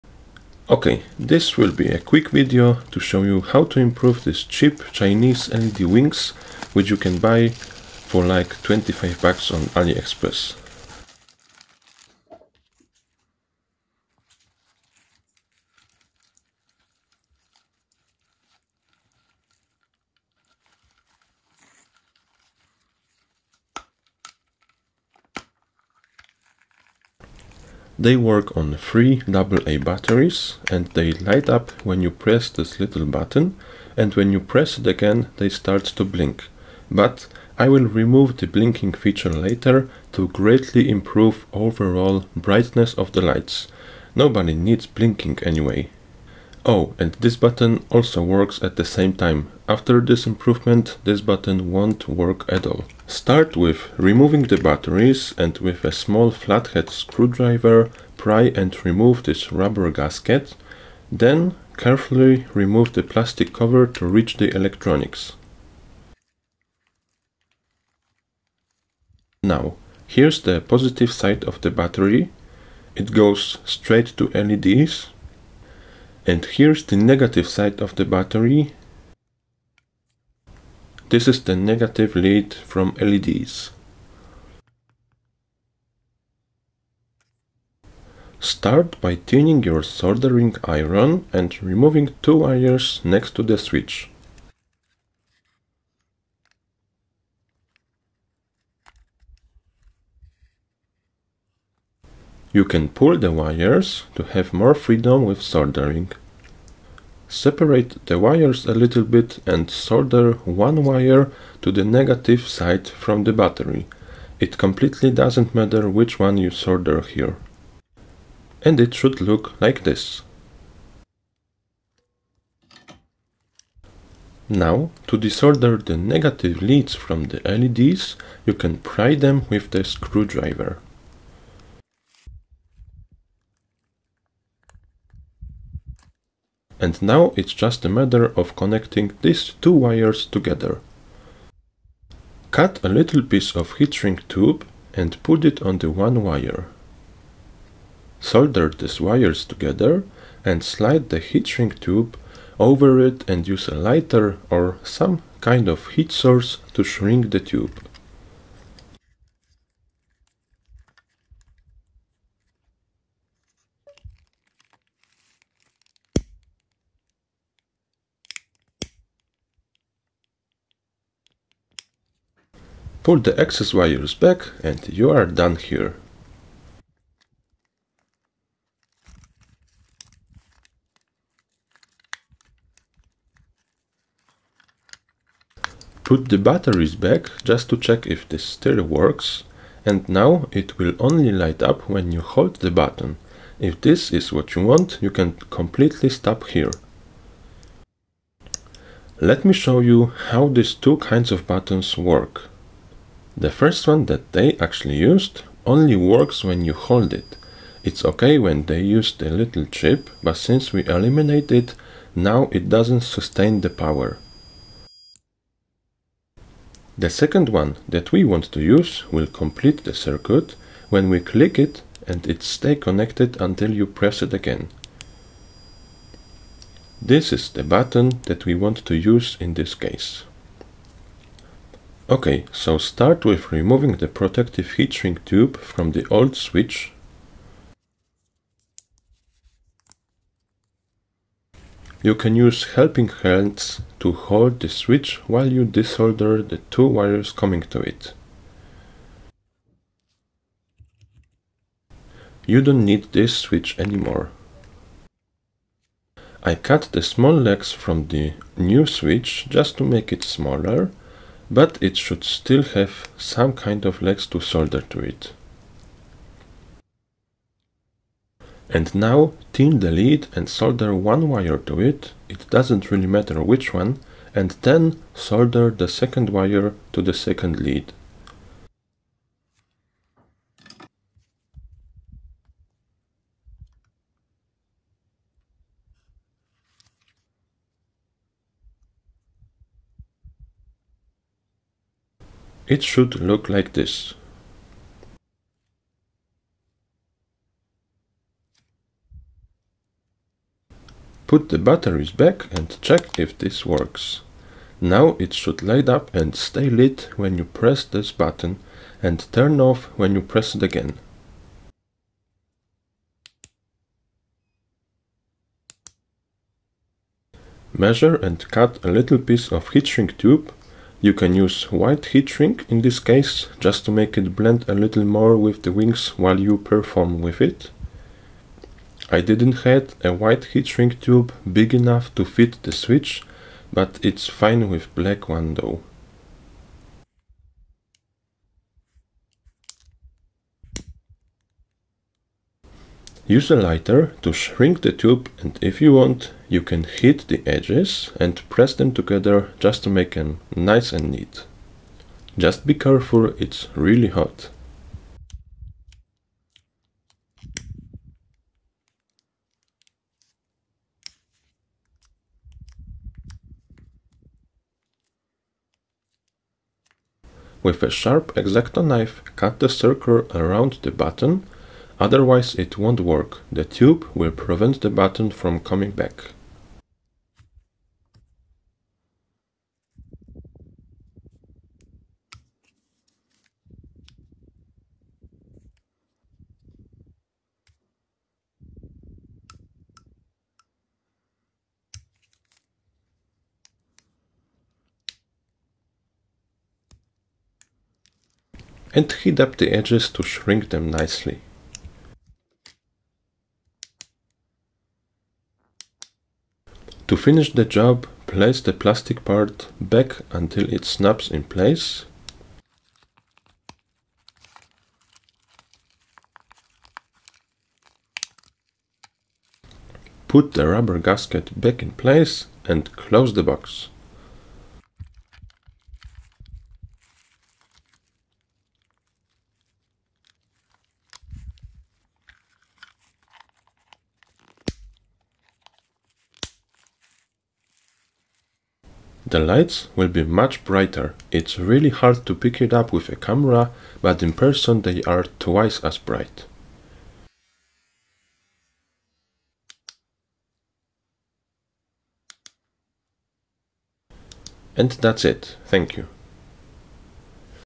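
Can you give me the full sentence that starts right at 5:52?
Just be careful, it's really hot.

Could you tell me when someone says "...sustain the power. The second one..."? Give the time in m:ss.
3:33.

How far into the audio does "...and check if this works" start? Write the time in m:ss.
5:02.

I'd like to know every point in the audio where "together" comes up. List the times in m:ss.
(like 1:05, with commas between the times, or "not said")
2:20, 2:29, 5:48.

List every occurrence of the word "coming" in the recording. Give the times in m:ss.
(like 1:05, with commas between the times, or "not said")
4:07, 6:15.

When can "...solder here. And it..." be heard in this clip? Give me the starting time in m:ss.
1:56.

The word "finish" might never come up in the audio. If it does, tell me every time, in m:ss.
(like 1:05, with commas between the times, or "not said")
6:47.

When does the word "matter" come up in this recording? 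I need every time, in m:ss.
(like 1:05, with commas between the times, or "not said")
1:55, 2:17, 4:33.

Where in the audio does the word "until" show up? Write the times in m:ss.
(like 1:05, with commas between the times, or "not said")
3:43, 6:50.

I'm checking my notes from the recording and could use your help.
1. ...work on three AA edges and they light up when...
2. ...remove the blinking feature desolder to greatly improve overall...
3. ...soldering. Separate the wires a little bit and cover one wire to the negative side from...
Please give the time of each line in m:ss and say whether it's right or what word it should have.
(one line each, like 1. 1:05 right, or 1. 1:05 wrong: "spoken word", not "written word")
1. 0:28 wrong: "batteries", not "edges"
2. 0:37 wrong: "later", not "desolder"
3. 1:45 wrong: "solder", not "cover".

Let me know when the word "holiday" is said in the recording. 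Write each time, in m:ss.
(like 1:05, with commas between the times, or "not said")
not said.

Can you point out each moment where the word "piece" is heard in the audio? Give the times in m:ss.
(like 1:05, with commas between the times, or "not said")
2:23, 5:19.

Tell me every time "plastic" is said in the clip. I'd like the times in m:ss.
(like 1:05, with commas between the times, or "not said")
1:03, 6:48.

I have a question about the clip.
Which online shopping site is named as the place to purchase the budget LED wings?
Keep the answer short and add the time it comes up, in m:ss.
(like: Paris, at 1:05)
AliExpress, at 0:09.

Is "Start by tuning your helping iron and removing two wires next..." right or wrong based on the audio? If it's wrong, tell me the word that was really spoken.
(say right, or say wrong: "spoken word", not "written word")
wrong: "soldering", not "helping".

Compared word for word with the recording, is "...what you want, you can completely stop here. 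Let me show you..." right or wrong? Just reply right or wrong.
right.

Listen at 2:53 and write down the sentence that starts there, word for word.
Pull the excess wires back and you are done here.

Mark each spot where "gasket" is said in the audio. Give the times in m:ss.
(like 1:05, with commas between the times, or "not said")
0:59, 7:00.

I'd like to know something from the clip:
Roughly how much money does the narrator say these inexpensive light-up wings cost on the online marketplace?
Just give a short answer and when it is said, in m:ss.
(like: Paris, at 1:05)
$25, at 0:08.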